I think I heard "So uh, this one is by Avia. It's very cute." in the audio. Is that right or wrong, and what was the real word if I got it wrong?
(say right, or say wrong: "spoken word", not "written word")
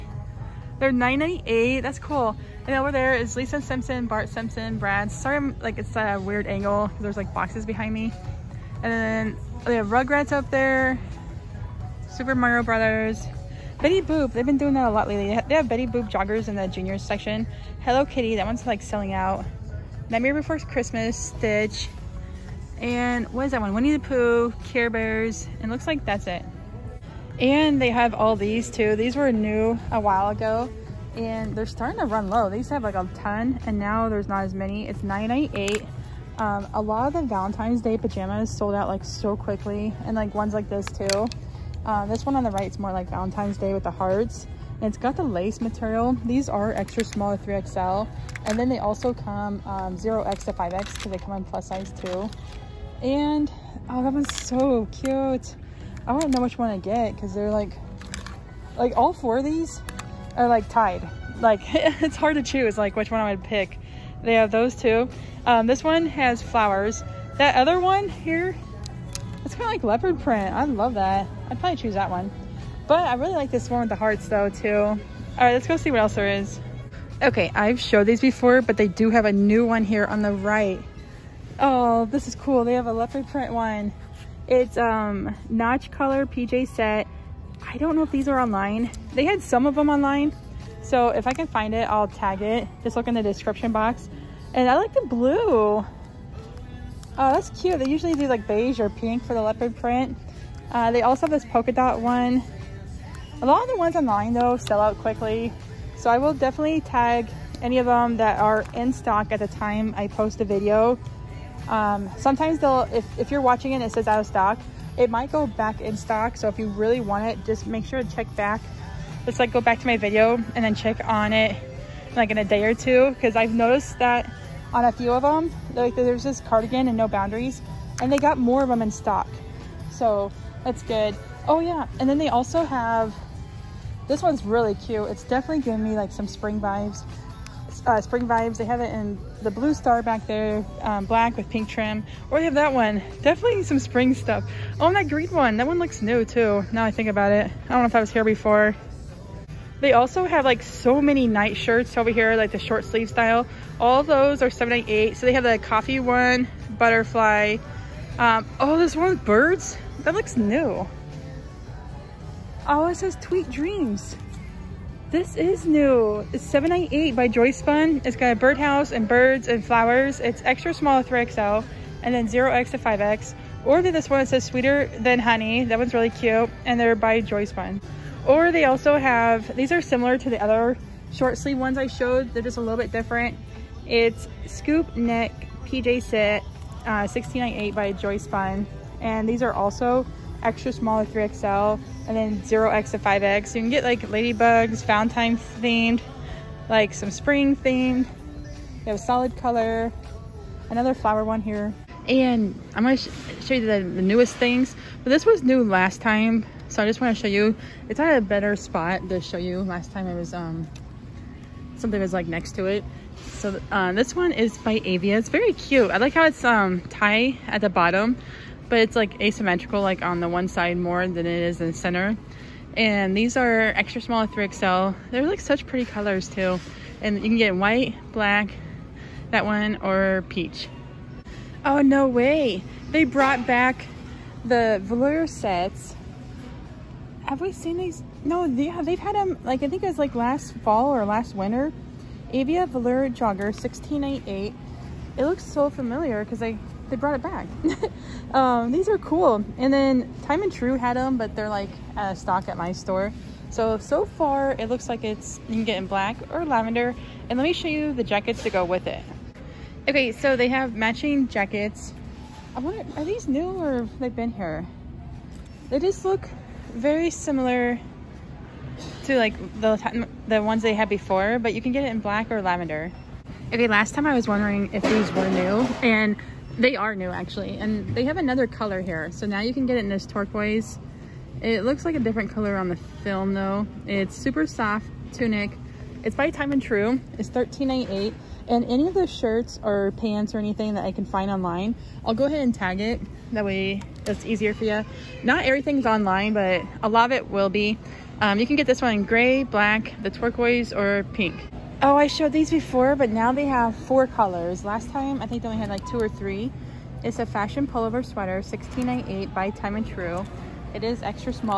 right.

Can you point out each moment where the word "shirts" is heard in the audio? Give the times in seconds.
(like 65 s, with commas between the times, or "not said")
151 s, 289 s.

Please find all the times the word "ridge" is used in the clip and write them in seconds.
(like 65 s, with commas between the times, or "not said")
not said.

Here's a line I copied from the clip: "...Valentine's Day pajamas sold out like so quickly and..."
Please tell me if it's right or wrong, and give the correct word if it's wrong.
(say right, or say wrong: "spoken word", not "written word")
right.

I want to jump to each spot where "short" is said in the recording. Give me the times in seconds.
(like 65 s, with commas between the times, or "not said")
152 s, 181 s.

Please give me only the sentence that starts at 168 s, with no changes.
It's got a birdhouse and birds and flowers.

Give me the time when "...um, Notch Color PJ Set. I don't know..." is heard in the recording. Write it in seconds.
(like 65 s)
84 s.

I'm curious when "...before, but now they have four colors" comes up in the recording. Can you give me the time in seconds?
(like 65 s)
302 s.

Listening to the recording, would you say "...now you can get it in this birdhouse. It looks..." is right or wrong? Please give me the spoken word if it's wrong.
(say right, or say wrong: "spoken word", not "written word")
wrong: "turquoise", not "birdhouse".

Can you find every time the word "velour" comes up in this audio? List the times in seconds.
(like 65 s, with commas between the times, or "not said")
234 s, 242 s.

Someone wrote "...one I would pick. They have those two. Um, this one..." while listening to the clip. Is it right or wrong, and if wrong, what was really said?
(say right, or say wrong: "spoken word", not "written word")
right.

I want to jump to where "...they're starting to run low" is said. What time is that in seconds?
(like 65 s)
31 s.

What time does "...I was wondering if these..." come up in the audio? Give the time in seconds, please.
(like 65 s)
274 s.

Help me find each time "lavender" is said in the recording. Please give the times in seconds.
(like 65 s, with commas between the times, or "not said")
256 s, 272 s.